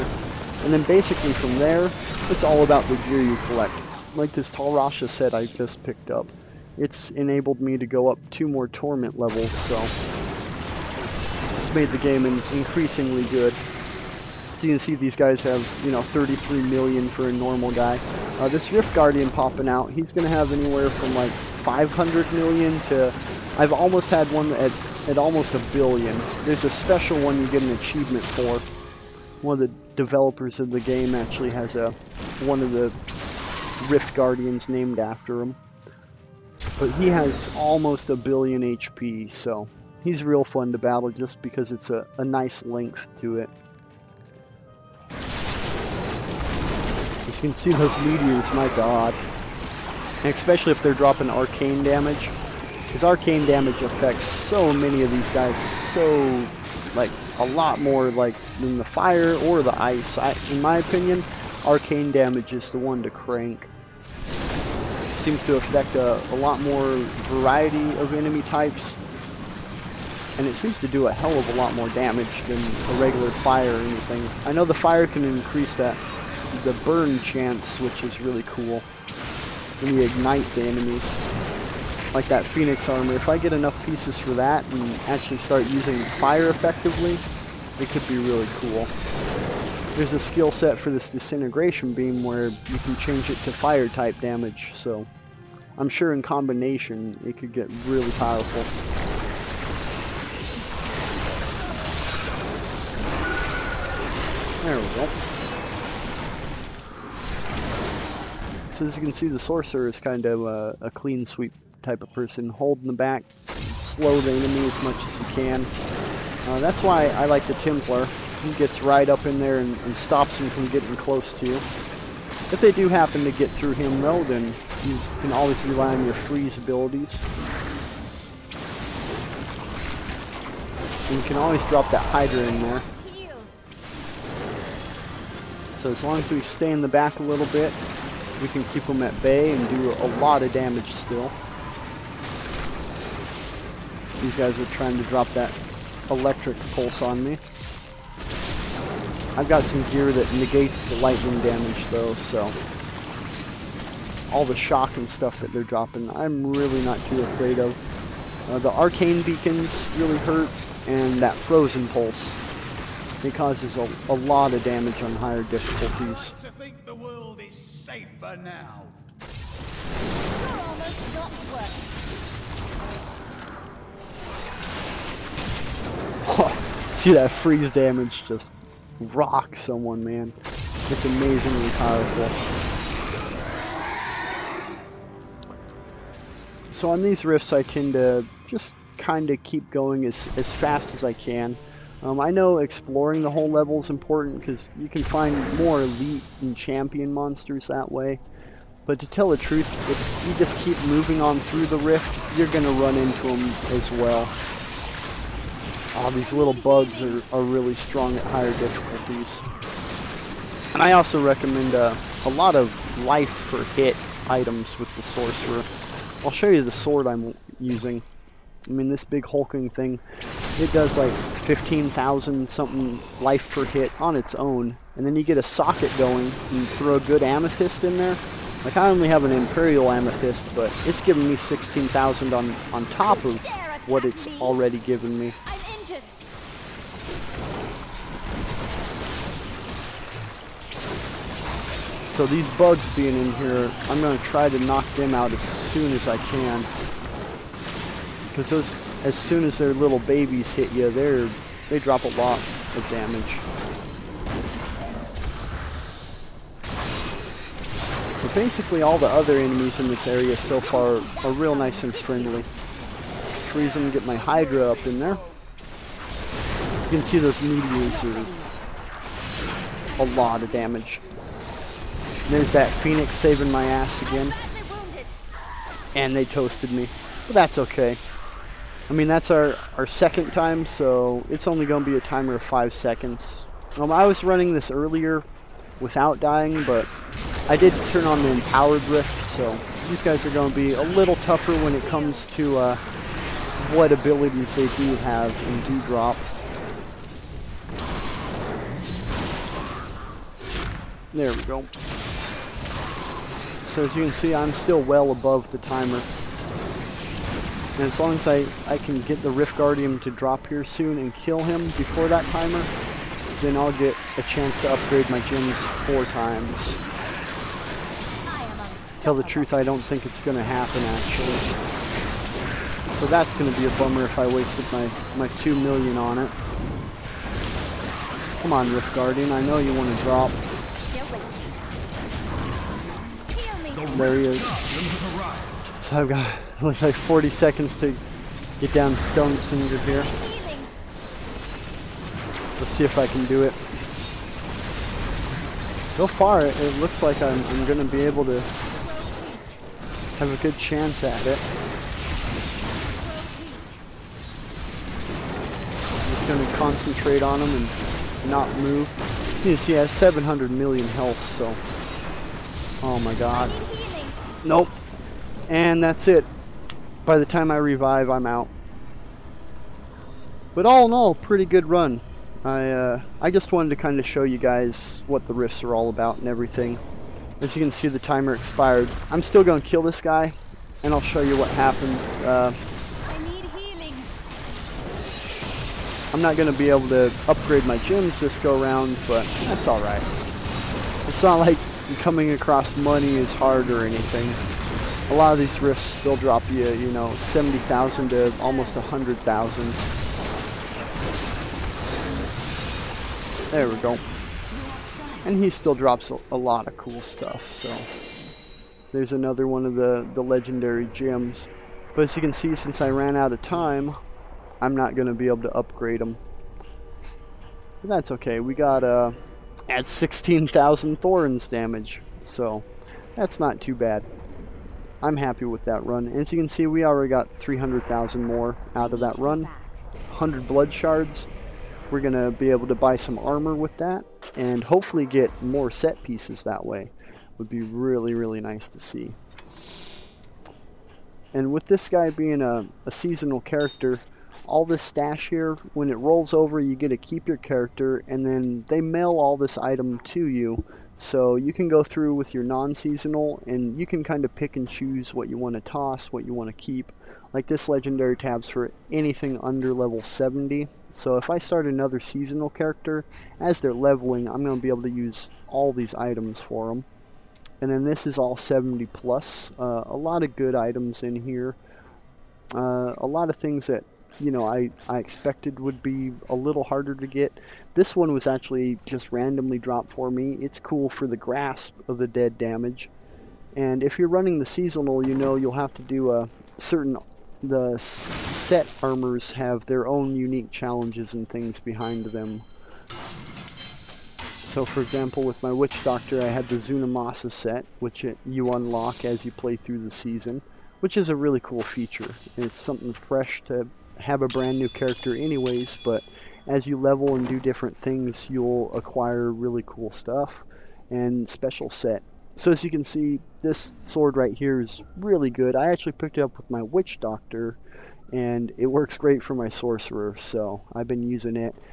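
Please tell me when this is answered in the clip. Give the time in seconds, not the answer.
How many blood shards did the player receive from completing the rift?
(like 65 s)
430 s.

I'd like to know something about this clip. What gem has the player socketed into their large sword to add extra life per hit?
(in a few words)
Imperial Amethyst.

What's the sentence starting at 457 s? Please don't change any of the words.
Like this legendary tabs for anything under level 70.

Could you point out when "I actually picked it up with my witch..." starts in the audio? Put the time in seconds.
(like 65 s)
515 s.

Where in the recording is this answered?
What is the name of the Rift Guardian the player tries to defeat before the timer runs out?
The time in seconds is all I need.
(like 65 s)
339 s.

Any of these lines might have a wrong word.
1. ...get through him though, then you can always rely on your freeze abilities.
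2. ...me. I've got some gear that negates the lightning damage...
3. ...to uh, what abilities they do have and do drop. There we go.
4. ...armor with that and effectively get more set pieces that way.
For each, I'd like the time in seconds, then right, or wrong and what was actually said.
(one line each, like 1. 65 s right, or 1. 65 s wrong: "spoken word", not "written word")
1. 123 s right
2. 147 s right
3. 292 s right
4. 433 s wrong: "hopefully", not "effectively".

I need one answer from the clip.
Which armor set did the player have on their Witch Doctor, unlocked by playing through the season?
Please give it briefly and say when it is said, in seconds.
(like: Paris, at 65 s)
Zunimassa, at 496 s.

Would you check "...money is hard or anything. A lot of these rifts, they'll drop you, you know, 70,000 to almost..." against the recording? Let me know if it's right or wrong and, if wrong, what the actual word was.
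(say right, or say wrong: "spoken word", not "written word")
right.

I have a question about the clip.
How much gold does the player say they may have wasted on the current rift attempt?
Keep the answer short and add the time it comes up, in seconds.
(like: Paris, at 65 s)
2 million, at 325 s.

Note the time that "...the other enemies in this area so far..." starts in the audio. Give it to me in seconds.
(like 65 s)
258 s.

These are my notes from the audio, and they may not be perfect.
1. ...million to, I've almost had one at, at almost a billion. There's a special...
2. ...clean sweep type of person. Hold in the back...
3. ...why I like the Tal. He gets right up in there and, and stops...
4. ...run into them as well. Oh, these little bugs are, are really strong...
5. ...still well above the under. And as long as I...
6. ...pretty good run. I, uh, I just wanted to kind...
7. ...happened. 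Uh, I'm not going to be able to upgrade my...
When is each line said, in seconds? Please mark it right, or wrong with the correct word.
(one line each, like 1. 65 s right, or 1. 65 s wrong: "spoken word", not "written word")
1. 22 s right
2. 110 s right
3. 116 s wrong: "Templar", not "Tal"
4. 202 s right
5. 304 s wrong: "timer", not "under"
6. 371 s right
7. 381 s right.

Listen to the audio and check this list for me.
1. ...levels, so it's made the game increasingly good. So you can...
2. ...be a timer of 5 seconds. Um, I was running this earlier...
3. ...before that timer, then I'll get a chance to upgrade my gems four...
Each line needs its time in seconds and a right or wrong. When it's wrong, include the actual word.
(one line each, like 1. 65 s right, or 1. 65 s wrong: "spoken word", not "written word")
1. 9 s right
2. 281 s right
3. 311 s right.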